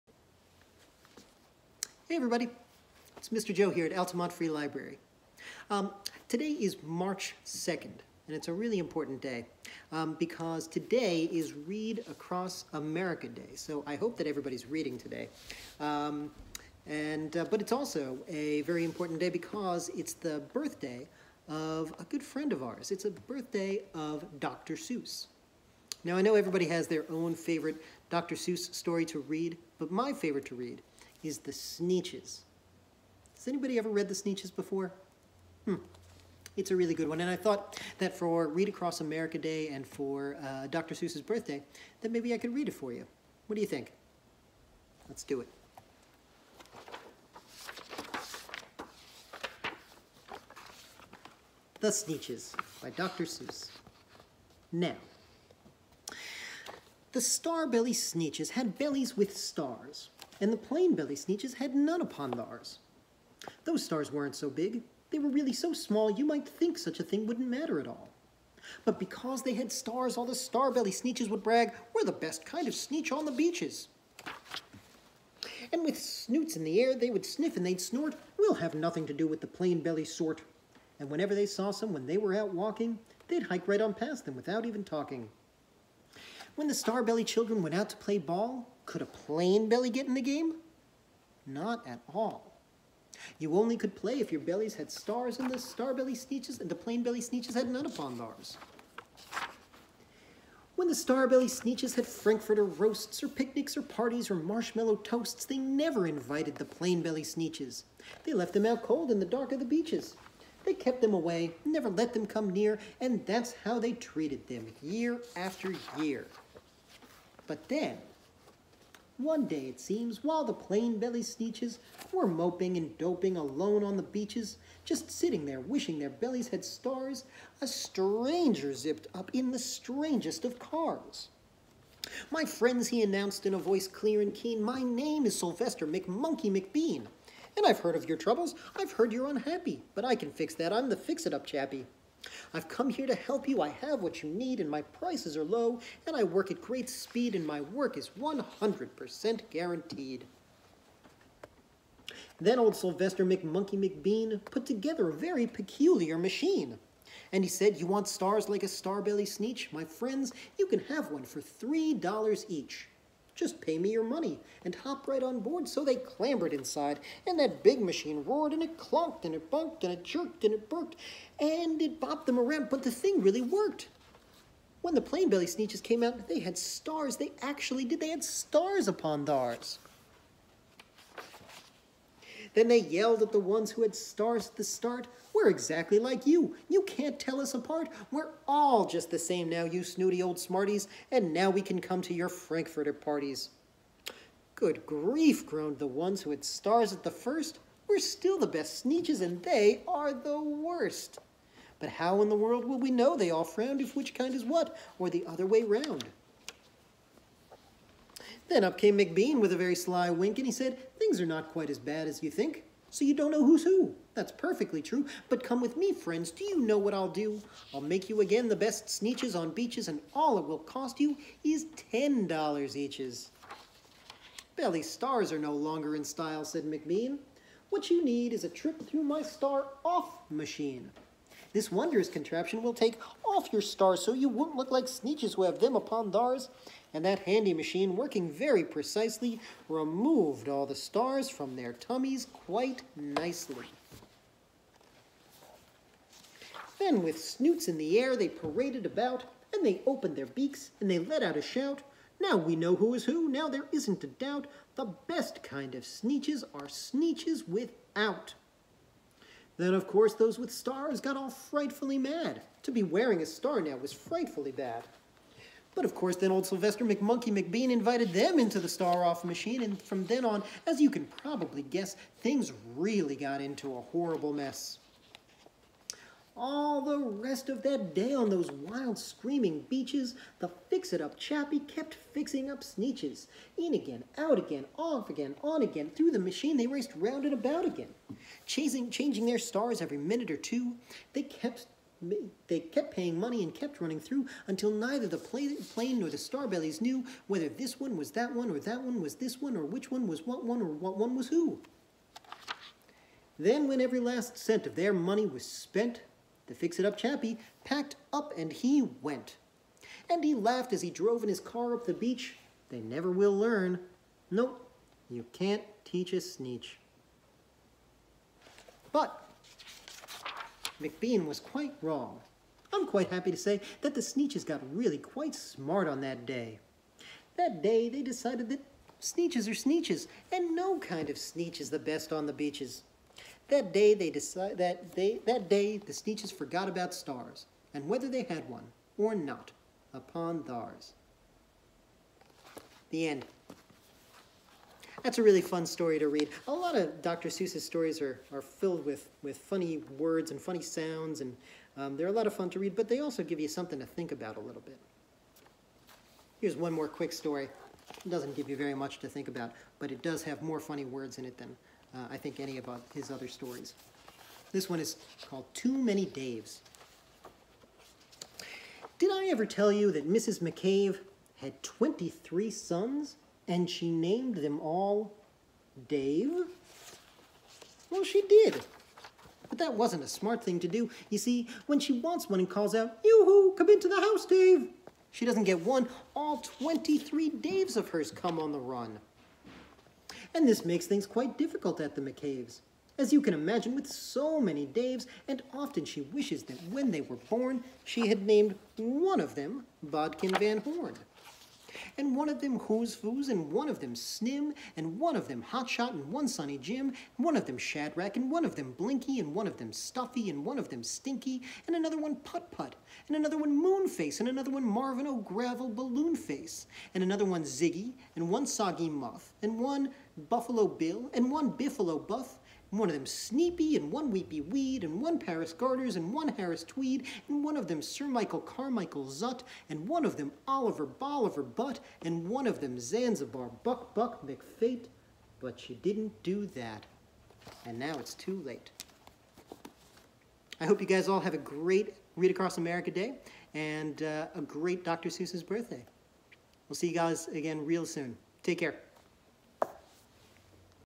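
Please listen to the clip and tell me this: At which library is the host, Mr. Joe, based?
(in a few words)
Altamont Free Library.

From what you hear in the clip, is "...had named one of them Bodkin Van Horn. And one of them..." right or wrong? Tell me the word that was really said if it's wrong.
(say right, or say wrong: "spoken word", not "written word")
right.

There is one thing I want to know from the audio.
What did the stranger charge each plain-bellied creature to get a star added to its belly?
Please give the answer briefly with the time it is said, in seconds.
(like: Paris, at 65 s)
$3, at 161 s.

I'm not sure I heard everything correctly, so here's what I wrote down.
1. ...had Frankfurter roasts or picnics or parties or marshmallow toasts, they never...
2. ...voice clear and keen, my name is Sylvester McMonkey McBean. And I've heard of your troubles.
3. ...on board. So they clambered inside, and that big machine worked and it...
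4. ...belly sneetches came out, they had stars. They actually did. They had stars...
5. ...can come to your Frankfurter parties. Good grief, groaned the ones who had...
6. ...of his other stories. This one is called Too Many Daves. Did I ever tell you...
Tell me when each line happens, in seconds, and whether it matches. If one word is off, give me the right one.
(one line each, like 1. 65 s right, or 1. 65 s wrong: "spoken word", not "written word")
1. 101 s right
2. 133 s right
3. 165 s wrong: "roared", not "worked"
4. 175 s right
5. 191 s right
6. 362 s right.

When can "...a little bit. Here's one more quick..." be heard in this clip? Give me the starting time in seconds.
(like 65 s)
354 s.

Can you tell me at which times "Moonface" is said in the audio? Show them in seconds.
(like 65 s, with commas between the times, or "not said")
413 s.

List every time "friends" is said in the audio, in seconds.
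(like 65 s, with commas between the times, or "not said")
22 s, 132 s, 159 s, 215 s.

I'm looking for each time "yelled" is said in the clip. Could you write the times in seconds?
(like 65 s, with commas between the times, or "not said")
182 s.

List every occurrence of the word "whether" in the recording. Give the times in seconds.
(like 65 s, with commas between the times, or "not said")
297 s, 337 s.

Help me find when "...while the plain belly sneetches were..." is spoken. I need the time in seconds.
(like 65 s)
120 s.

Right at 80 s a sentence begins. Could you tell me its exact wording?
And whenever they saw some when they were out walking, they'd hike right on past them without even talking.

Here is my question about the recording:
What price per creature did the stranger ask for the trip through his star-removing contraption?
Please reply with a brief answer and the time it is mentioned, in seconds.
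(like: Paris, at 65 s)
$10, at 221 s.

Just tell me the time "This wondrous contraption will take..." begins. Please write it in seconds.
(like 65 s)
231 s.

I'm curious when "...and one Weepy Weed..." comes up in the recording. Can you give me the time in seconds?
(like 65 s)
423 s.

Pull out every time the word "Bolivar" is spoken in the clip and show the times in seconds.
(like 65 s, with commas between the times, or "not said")
430 s.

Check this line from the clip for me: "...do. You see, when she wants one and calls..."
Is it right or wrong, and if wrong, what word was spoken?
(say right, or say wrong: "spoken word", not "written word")
right.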